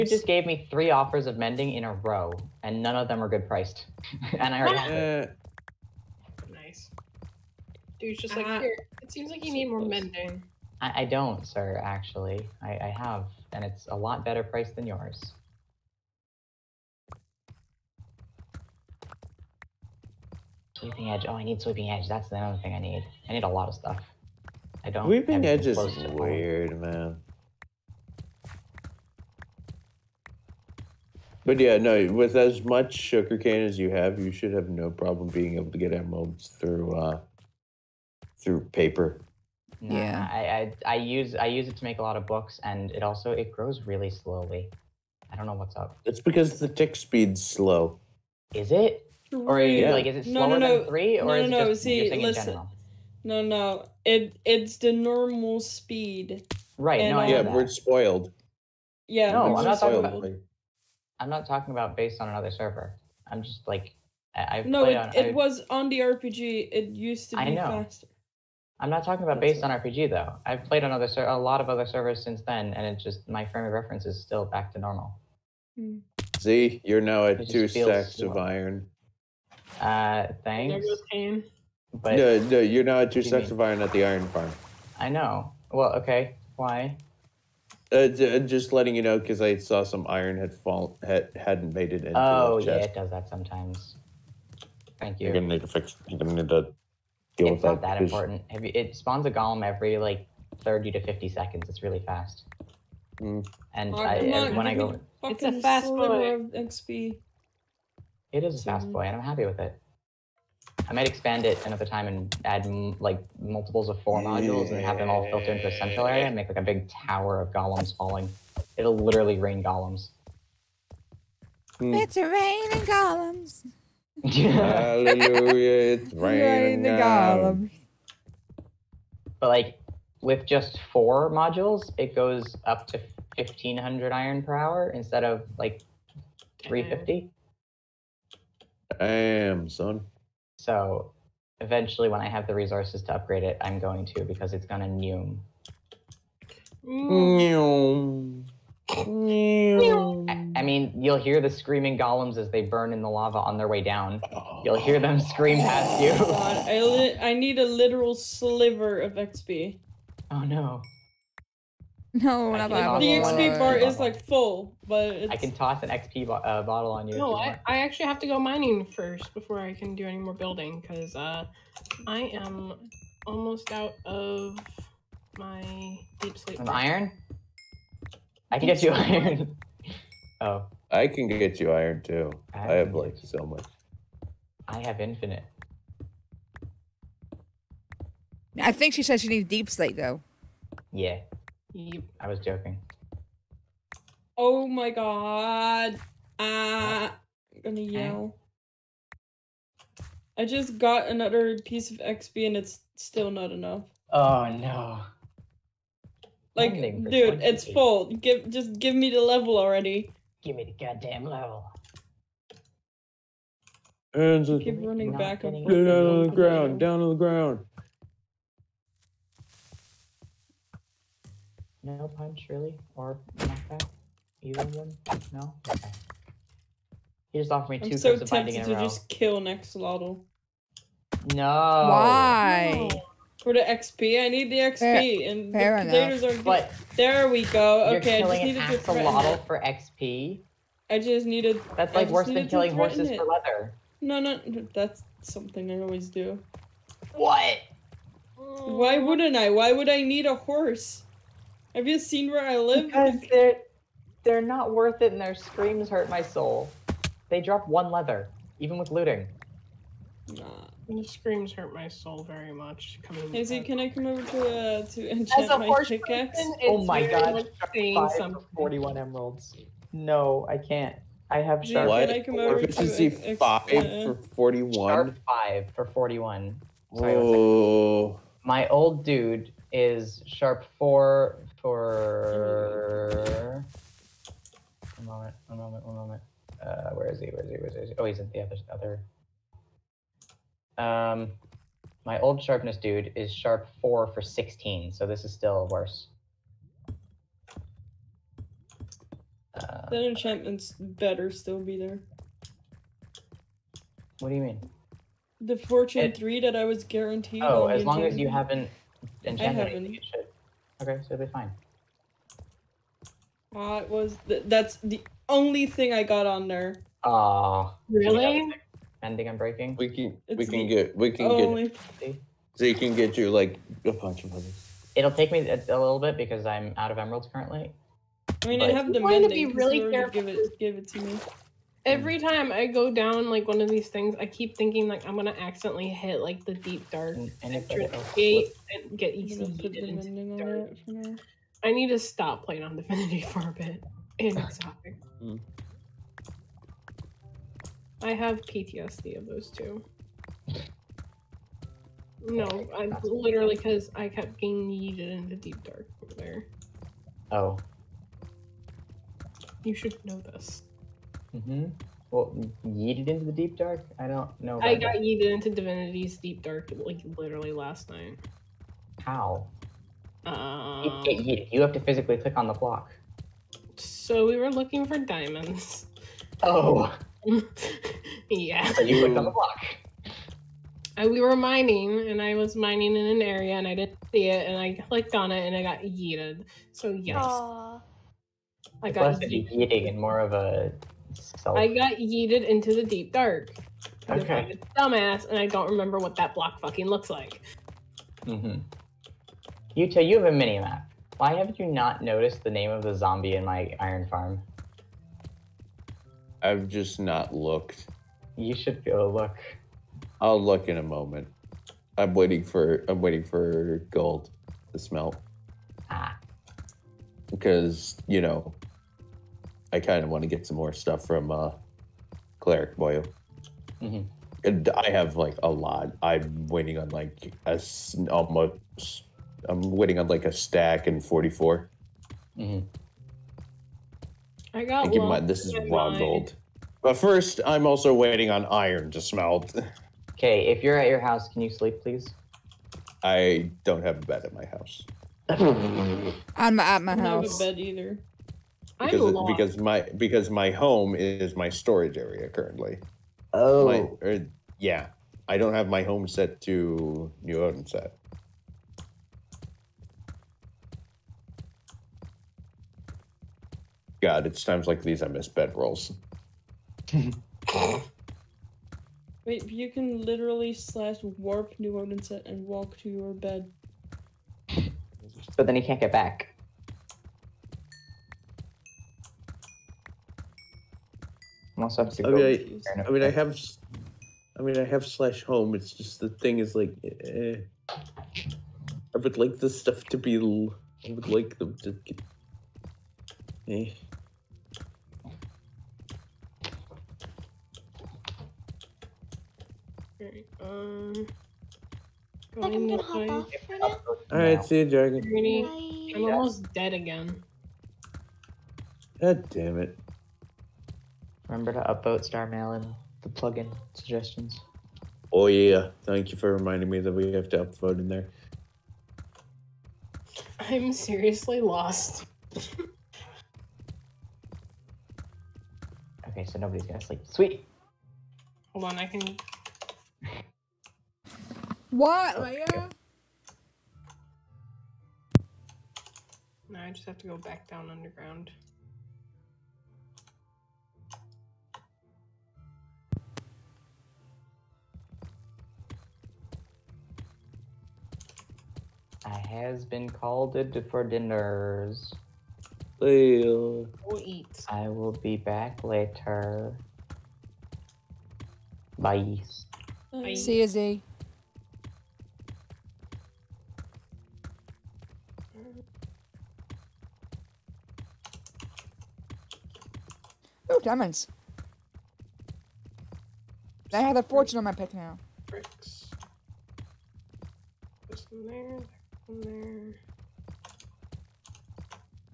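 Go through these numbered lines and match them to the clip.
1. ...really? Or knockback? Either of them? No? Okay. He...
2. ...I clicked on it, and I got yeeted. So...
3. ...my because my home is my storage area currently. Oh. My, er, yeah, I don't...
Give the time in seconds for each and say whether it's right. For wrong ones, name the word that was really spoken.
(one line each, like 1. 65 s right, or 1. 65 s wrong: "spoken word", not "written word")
1. 222 s right
2. 384 s right
3. 449 s right.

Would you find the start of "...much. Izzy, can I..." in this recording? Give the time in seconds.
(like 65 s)
262 s.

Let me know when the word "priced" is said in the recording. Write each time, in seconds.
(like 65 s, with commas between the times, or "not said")
3 s, 14 s.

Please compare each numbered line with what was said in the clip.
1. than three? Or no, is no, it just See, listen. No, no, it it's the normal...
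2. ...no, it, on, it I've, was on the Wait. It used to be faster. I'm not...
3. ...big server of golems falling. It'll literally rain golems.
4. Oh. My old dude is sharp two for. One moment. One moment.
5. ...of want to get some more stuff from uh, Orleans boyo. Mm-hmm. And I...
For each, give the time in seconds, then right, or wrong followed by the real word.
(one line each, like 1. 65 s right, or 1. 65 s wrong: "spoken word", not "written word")
1. 50 s right
2. 64 s wrong: "RPG", not "Wait"
3. 116 s wrong: "tower", not "server"
4. 278 s wrong: "four", not "two"
5. 420 s wrong: "Cleric", not "Orleans".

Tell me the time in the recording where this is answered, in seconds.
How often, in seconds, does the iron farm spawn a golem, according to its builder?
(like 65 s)
100 s.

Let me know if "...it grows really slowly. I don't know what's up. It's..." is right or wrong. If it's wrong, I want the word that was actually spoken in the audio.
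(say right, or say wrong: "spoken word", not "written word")
right.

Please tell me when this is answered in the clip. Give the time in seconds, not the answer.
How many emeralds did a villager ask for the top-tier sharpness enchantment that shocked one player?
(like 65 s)
267 s.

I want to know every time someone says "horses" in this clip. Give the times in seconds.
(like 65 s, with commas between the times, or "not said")
242 s, 250 s.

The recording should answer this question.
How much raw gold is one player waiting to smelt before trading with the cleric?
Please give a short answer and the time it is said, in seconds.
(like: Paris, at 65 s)
A stack and 44, at 430 s.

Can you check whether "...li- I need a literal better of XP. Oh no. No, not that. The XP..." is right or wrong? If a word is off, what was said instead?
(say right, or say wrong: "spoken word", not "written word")
wrong: "sliver", not "better".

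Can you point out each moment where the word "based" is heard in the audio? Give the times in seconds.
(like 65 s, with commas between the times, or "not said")
61 s, 69 s.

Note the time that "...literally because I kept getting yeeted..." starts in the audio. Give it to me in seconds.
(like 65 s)
353 s.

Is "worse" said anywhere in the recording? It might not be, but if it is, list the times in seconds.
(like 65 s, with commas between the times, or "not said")
242 s, 295 s.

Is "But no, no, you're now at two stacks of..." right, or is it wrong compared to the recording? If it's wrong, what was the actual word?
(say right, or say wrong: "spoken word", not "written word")
right.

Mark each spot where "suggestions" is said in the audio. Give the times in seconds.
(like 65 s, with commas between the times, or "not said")
513 s.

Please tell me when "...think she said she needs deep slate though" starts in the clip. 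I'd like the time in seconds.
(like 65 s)
188 s.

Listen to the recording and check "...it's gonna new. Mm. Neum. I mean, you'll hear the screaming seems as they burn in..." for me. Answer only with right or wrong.
wrong.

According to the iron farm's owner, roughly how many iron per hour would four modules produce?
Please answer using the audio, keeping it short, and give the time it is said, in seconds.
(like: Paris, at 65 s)
1500, at 133 s.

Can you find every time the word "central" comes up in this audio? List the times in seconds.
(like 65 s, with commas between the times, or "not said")
115 s.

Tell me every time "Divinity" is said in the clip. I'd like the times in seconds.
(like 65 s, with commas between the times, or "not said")
342 s, 365 s.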